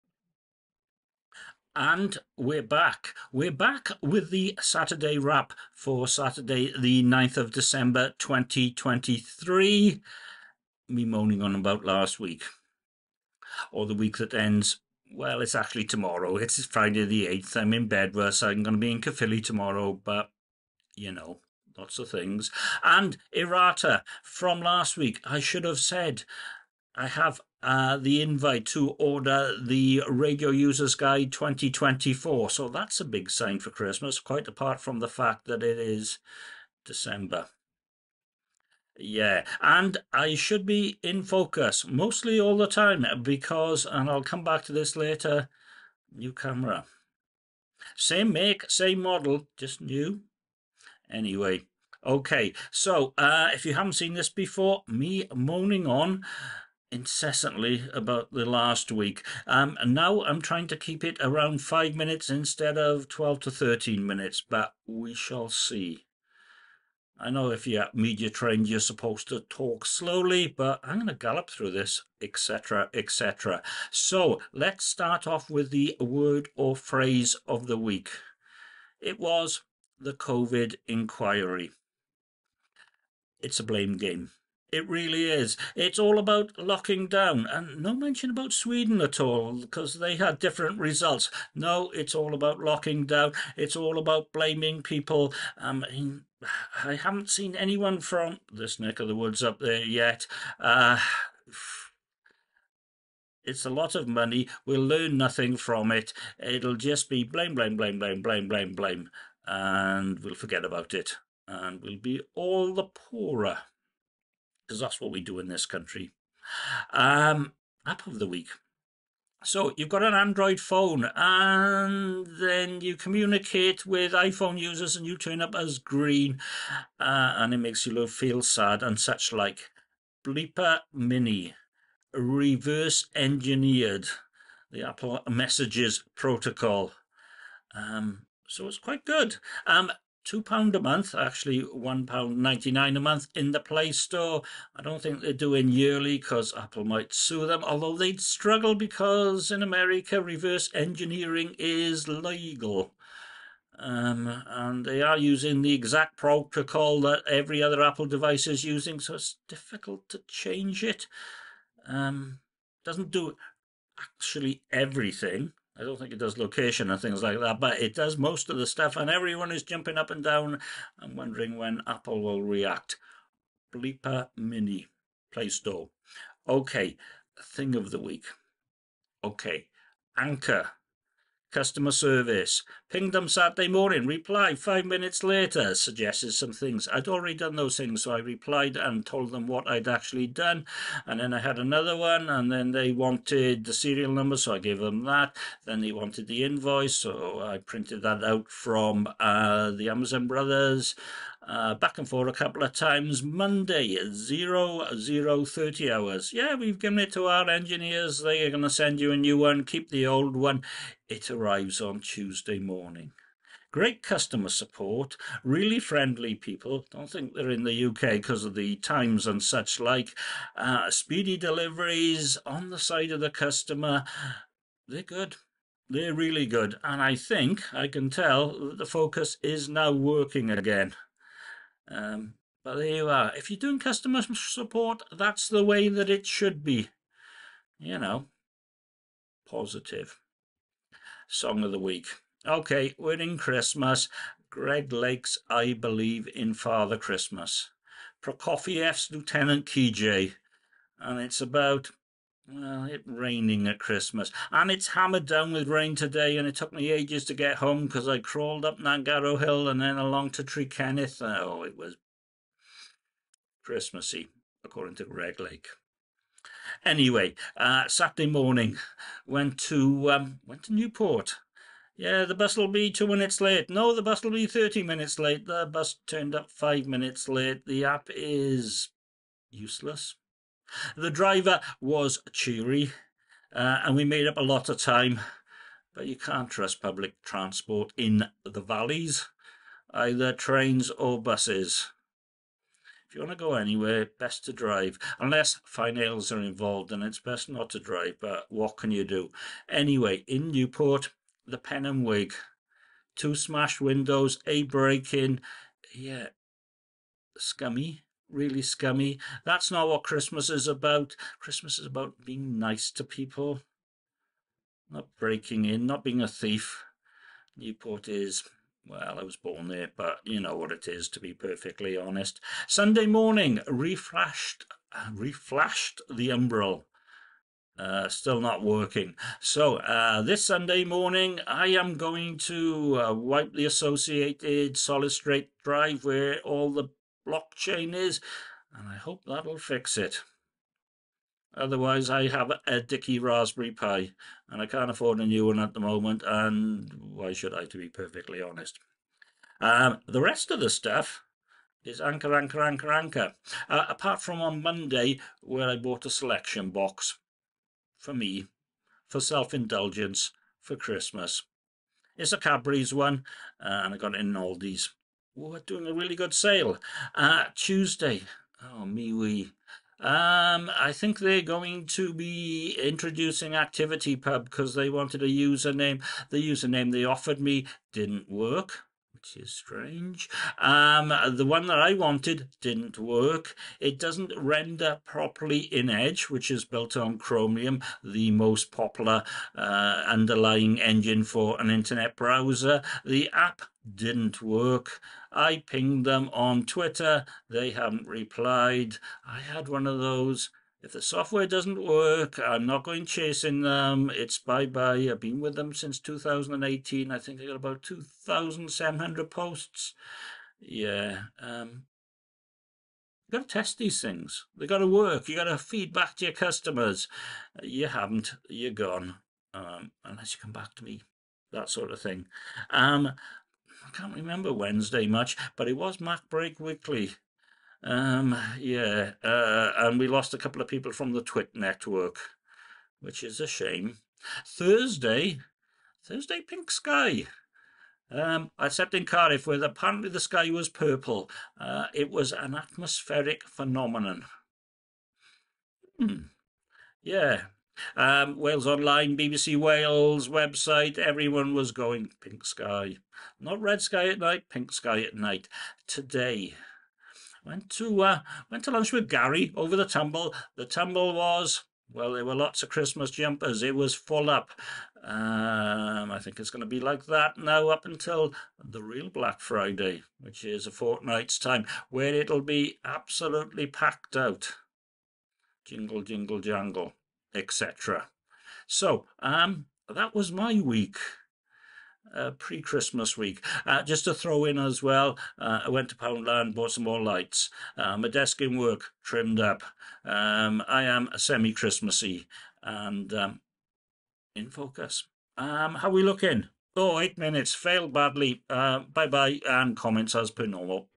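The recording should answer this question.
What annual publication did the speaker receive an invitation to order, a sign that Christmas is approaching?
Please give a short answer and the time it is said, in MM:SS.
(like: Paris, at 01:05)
Radio Users Guide 2024, at 00:30.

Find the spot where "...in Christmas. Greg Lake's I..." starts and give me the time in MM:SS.
04:03.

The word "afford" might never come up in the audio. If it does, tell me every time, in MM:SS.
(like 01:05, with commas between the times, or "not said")
05:44.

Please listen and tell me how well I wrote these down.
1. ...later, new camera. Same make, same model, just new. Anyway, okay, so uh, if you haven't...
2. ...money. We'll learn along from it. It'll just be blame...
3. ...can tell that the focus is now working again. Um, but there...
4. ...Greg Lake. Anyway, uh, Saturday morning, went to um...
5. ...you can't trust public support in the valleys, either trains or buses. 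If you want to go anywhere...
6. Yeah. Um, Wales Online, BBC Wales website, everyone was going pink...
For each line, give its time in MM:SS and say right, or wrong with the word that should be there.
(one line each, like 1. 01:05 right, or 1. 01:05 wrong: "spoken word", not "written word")
1. 00:44 right
2. 01:44 wrong: "nothing", not "along"
3. 03:47 right
4. 04:25 right
5. 04:46 wrong: "transport", not "support"
6. 07:27 right.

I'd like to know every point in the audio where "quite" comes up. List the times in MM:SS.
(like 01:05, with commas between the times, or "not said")
00:34, 02:18.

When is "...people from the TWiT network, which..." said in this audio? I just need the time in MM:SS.
07:10.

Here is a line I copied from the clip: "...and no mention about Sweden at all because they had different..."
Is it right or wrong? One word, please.
right.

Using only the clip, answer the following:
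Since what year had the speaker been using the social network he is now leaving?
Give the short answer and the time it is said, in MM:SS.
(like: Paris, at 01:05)
2018, at 06:45.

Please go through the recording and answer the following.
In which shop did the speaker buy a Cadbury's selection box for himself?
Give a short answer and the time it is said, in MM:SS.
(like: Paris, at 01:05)
Aldi, at 06:04.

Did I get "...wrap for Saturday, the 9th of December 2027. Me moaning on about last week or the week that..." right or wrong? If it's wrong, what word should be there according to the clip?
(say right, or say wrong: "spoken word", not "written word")
wrong: "2023", not "2027".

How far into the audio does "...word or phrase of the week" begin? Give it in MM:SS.
01:15.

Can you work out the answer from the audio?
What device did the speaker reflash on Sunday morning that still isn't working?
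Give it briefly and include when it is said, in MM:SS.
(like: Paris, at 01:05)
Umbrel, at 05:26.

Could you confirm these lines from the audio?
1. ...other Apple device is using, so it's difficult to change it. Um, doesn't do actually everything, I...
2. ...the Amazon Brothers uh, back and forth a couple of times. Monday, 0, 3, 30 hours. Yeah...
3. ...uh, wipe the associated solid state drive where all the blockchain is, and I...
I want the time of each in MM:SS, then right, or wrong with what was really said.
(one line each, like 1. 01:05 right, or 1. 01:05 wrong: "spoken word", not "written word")
1. 02:37 right
2. 03:19 wrong: "0", not "3"
3. 05:33 right.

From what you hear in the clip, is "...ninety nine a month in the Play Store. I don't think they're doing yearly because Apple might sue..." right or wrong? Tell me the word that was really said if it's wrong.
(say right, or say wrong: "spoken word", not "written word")
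right.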